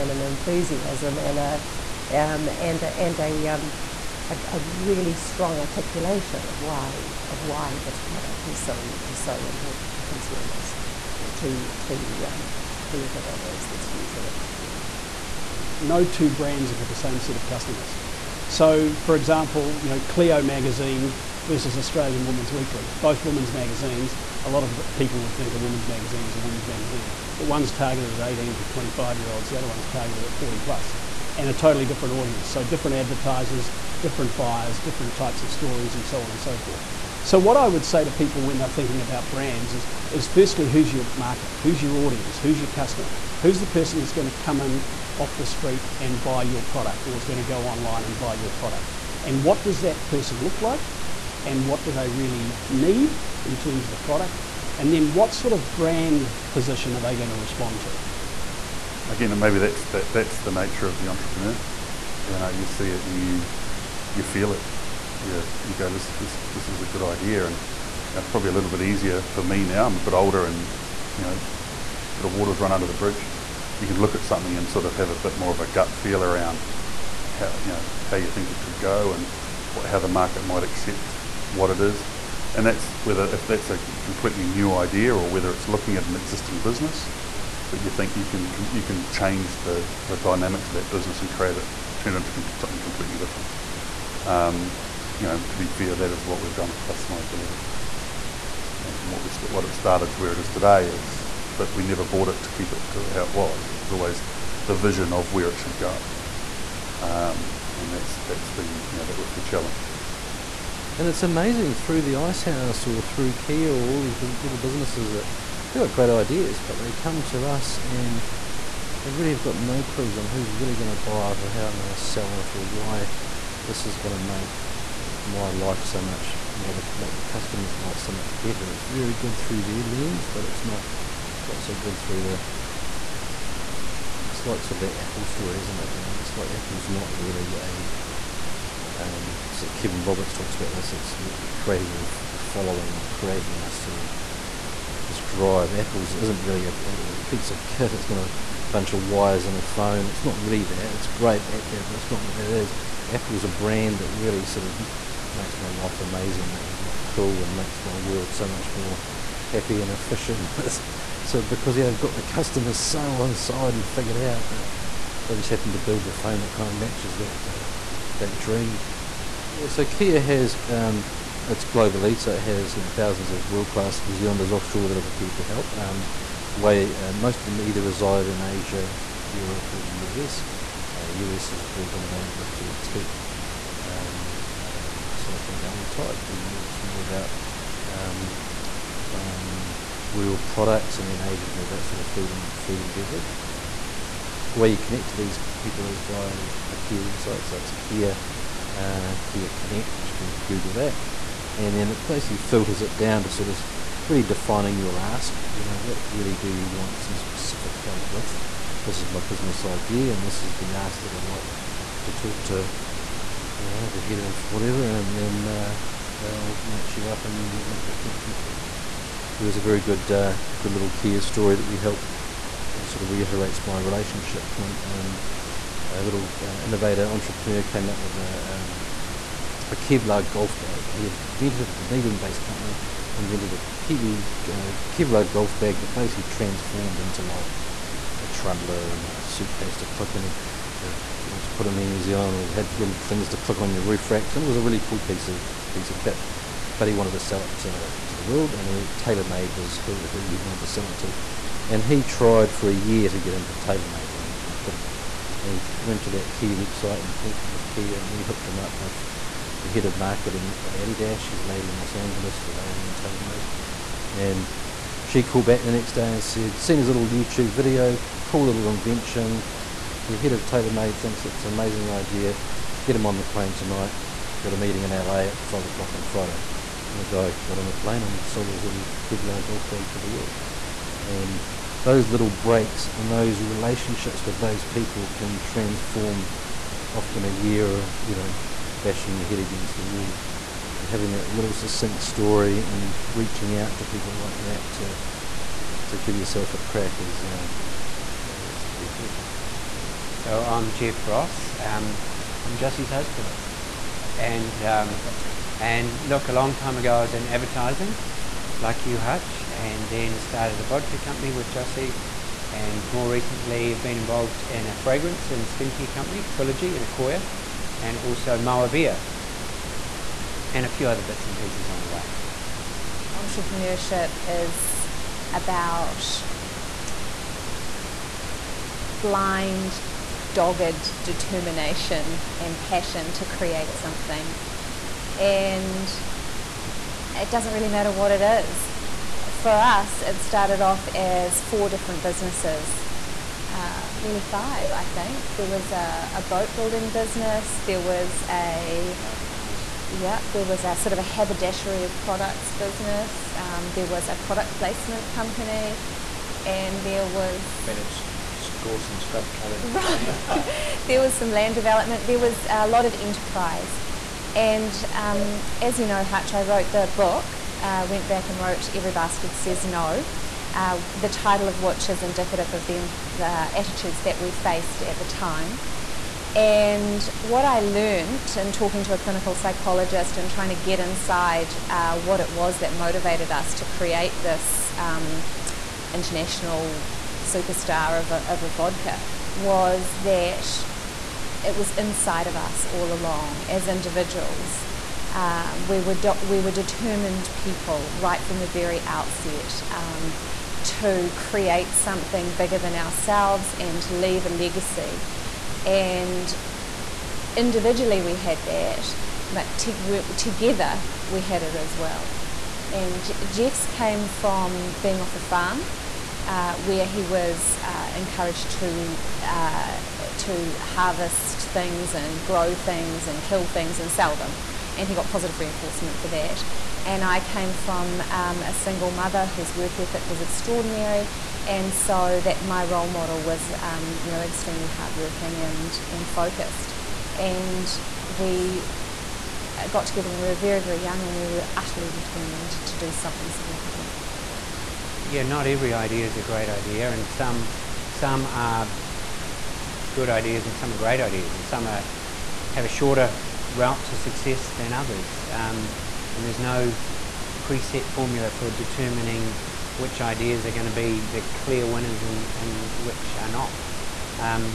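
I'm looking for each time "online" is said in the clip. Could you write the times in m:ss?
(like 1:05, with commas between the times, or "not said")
0:47.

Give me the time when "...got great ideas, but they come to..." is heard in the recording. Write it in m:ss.
1:55.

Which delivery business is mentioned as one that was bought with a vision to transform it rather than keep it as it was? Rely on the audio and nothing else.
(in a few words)
Customized Deliveries.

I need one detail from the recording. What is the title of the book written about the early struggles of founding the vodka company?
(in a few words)
Every Bastard Says No.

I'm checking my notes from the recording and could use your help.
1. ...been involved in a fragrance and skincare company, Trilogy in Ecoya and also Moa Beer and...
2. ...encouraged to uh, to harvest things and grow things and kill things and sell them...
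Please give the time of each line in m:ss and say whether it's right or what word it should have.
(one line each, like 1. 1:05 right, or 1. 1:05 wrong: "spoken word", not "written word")
1. 5:13 right
2. 6:57 right.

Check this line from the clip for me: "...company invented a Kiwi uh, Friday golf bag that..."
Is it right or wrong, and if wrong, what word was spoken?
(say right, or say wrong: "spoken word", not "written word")
wrong: "Kevlar", not "Friday".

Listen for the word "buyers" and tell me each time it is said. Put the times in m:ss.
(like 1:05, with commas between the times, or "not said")
0:34.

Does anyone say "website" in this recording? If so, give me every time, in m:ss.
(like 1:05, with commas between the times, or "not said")
3:17, 4:16.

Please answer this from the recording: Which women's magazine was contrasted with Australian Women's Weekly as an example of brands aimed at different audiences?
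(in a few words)
Cleo.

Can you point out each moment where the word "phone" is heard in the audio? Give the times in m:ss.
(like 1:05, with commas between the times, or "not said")
2:29, 2:46.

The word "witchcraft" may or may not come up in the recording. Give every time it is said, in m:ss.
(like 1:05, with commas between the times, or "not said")
not said.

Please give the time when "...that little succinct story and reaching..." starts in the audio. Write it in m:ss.
4:51.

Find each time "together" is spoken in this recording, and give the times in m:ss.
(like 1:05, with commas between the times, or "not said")
6:49, 7:19.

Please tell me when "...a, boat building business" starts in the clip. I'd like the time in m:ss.
5:46.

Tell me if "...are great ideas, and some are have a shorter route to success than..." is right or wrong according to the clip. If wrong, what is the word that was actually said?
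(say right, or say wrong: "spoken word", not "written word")
right.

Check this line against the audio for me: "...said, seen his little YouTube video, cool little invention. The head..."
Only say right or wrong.
right.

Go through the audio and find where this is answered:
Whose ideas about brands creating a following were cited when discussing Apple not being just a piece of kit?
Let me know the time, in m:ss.
2:19.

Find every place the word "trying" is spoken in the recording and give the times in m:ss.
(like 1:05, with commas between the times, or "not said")
6:20.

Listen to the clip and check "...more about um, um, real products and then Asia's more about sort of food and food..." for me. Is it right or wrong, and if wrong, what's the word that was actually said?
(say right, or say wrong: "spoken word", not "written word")
right.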